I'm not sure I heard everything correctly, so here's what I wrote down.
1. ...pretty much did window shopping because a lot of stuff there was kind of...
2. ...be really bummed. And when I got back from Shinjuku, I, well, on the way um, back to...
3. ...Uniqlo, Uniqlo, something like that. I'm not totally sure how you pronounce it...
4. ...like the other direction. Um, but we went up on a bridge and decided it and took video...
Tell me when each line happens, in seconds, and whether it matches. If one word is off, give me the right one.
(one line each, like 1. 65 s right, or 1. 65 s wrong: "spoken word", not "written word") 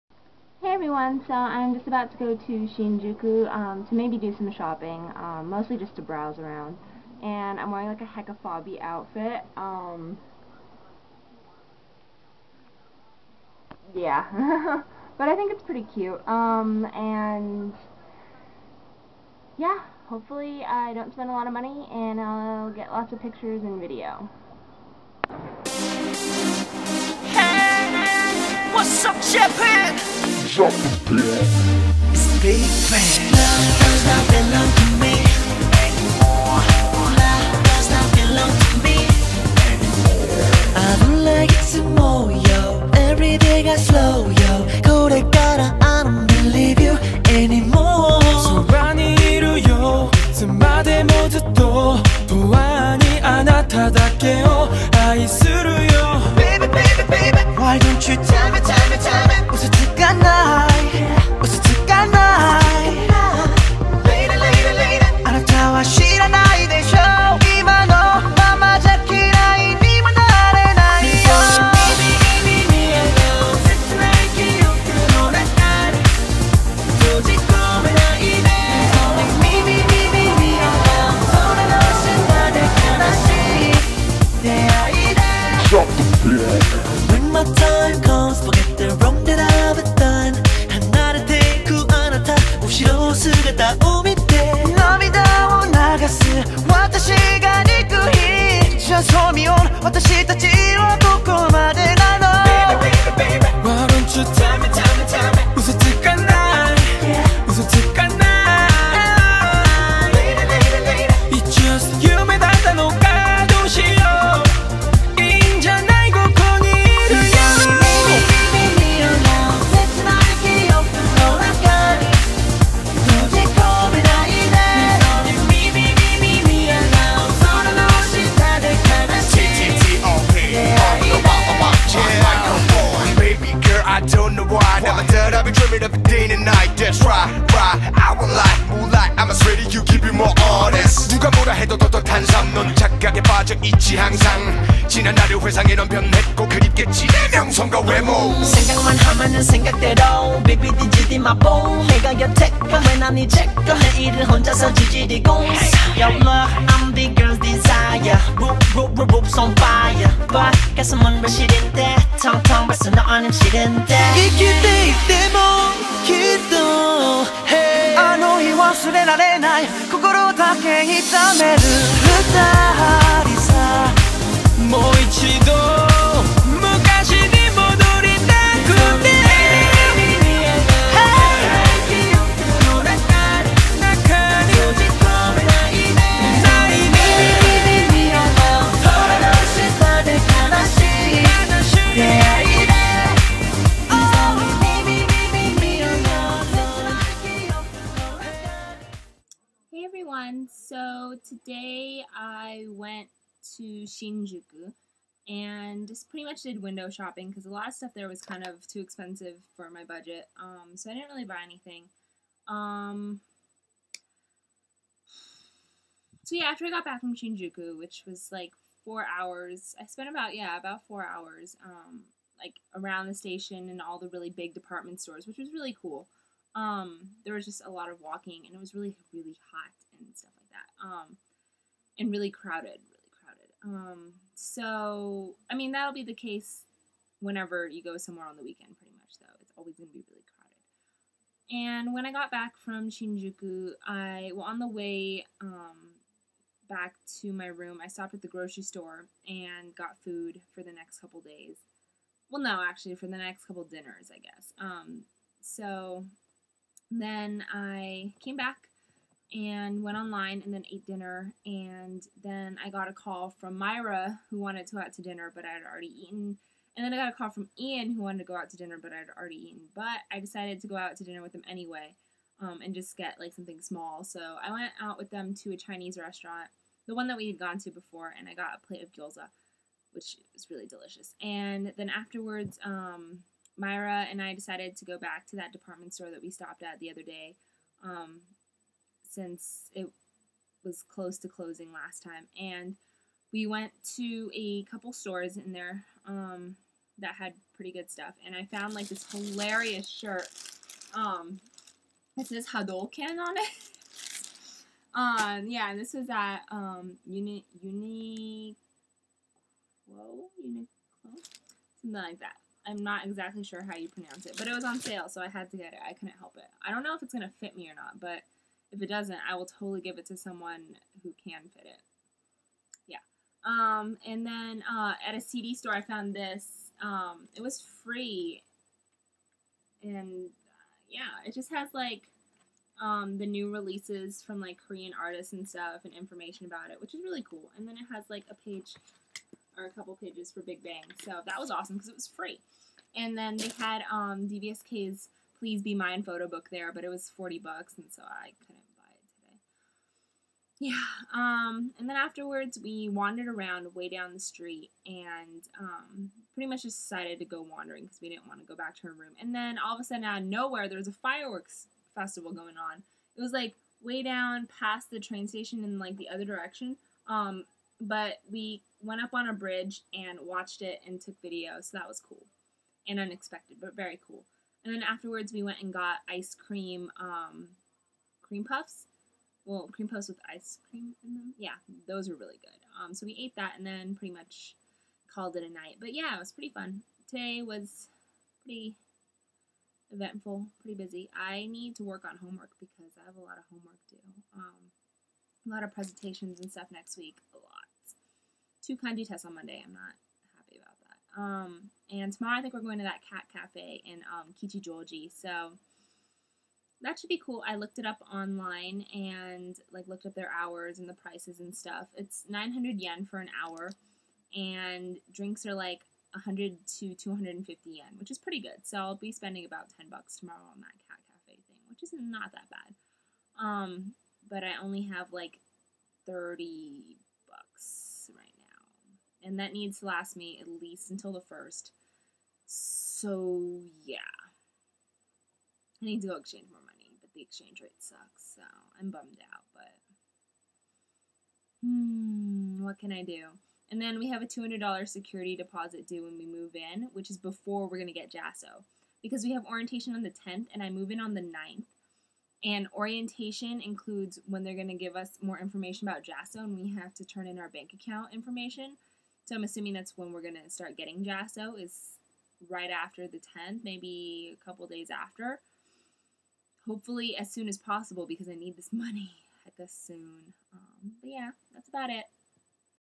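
1. 206 s right
2. 239 s wrong: "crowded", not "bummed"
3. 307 s wrong: "exactly", not "totally"
4. 365 s wrong: "watched", not "decided".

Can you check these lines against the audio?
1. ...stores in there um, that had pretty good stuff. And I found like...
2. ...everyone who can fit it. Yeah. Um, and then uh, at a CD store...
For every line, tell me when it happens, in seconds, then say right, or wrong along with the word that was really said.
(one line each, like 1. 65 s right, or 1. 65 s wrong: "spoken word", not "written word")
1. 294 s right
2. 320 s wrong: "someone", not "everyone".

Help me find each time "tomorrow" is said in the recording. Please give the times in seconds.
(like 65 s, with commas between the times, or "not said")
402 s, 420 s.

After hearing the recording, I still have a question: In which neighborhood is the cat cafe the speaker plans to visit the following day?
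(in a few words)
Kichijoji.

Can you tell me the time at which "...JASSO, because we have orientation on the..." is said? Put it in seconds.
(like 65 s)
448 s.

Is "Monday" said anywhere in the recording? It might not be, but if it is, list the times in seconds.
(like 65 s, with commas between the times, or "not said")
399 s.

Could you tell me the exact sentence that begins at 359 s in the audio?
And then all of a sudden out of nowhere there was a fireworks festival going on.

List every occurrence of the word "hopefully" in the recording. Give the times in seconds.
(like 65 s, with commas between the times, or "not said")
20 s, 466 s.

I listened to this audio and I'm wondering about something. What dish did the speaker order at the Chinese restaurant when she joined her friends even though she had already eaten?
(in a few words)
gyoza.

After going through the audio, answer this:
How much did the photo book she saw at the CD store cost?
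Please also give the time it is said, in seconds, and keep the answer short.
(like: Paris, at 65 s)
40 bucks, at 347 s.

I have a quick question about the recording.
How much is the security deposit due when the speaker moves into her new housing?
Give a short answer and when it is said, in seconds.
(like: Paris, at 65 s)
$200, at 444 s.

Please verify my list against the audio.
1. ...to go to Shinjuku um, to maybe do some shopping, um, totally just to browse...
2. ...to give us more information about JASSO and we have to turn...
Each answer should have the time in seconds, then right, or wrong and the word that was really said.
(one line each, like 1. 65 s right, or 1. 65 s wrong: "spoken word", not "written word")
1. 2 s wrong: "mostly", not "totally"
2. 454 s right.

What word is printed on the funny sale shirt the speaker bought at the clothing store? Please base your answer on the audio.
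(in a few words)
Hadouken.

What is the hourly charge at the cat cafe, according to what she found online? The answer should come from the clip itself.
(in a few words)
900 yen.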